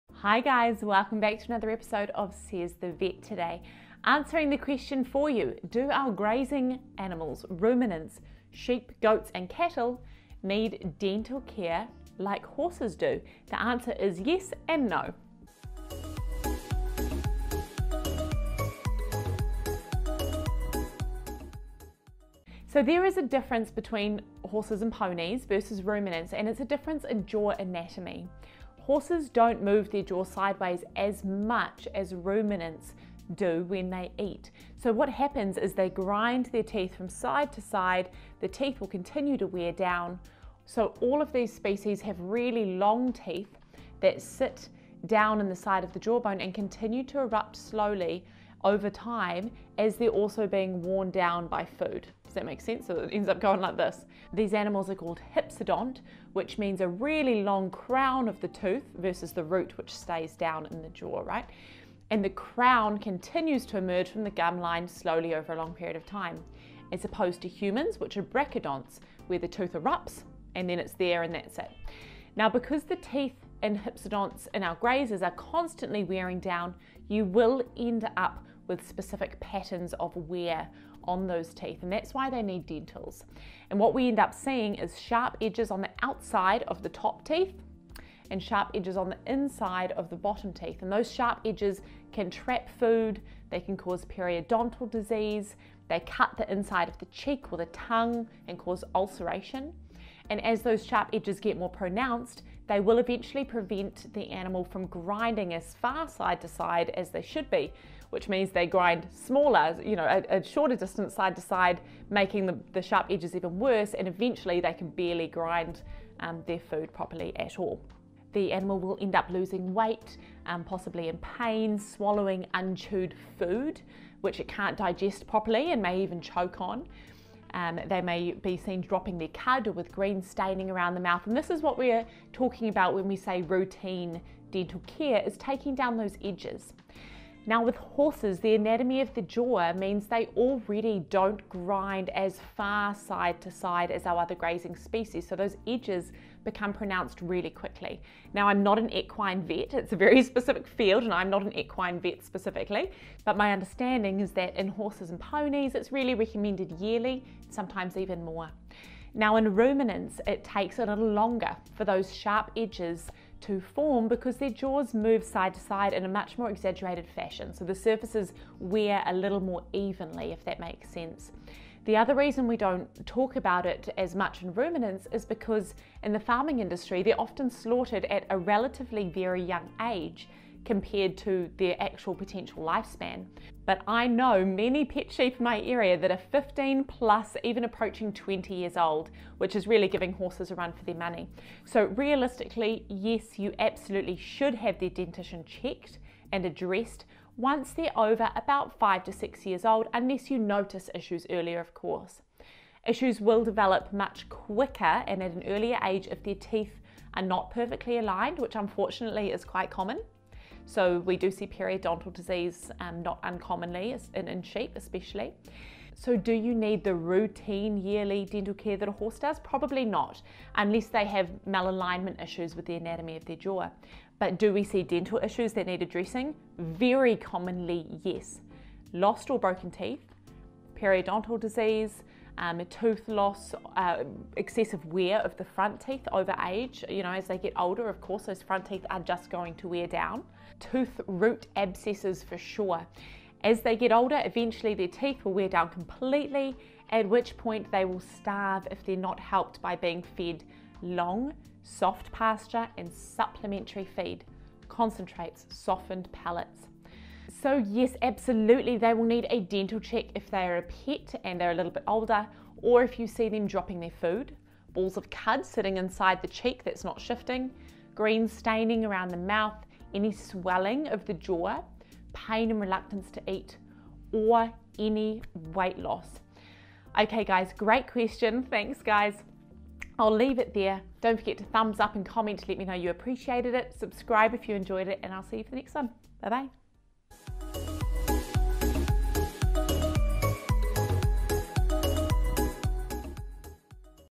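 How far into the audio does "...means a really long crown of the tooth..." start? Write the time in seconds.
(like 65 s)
56 s.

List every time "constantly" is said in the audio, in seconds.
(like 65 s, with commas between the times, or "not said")
75 s.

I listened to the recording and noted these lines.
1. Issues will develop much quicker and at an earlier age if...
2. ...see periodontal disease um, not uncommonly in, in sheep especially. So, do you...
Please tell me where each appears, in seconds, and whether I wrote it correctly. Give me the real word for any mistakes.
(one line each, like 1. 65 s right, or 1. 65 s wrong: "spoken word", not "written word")
1. 202 s right
2. 211 s right.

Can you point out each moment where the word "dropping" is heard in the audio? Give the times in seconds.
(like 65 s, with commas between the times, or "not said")
128 s, 263 s.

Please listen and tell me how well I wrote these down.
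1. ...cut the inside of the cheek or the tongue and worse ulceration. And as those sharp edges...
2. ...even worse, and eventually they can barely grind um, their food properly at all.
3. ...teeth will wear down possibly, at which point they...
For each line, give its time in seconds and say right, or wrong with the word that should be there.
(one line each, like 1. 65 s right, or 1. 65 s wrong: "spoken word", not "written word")
1. 96 s wrong: "cause", not "worse"
2. 113 s right
3. 244 s wrong: "completely", not "possibly".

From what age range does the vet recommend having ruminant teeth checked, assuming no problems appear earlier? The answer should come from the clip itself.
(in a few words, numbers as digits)
5 to 6 years.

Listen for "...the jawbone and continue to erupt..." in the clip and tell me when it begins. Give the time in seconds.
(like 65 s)
45 s.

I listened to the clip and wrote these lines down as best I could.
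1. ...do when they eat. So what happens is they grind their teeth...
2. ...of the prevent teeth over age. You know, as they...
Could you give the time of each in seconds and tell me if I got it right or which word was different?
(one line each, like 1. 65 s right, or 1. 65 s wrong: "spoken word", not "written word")
1. 33 s right
2. 235 s wrong: "front", not "prevent".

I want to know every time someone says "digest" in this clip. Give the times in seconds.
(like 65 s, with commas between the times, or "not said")
124 s.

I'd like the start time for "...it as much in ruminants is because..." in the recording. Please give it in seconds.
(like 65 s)
173 s.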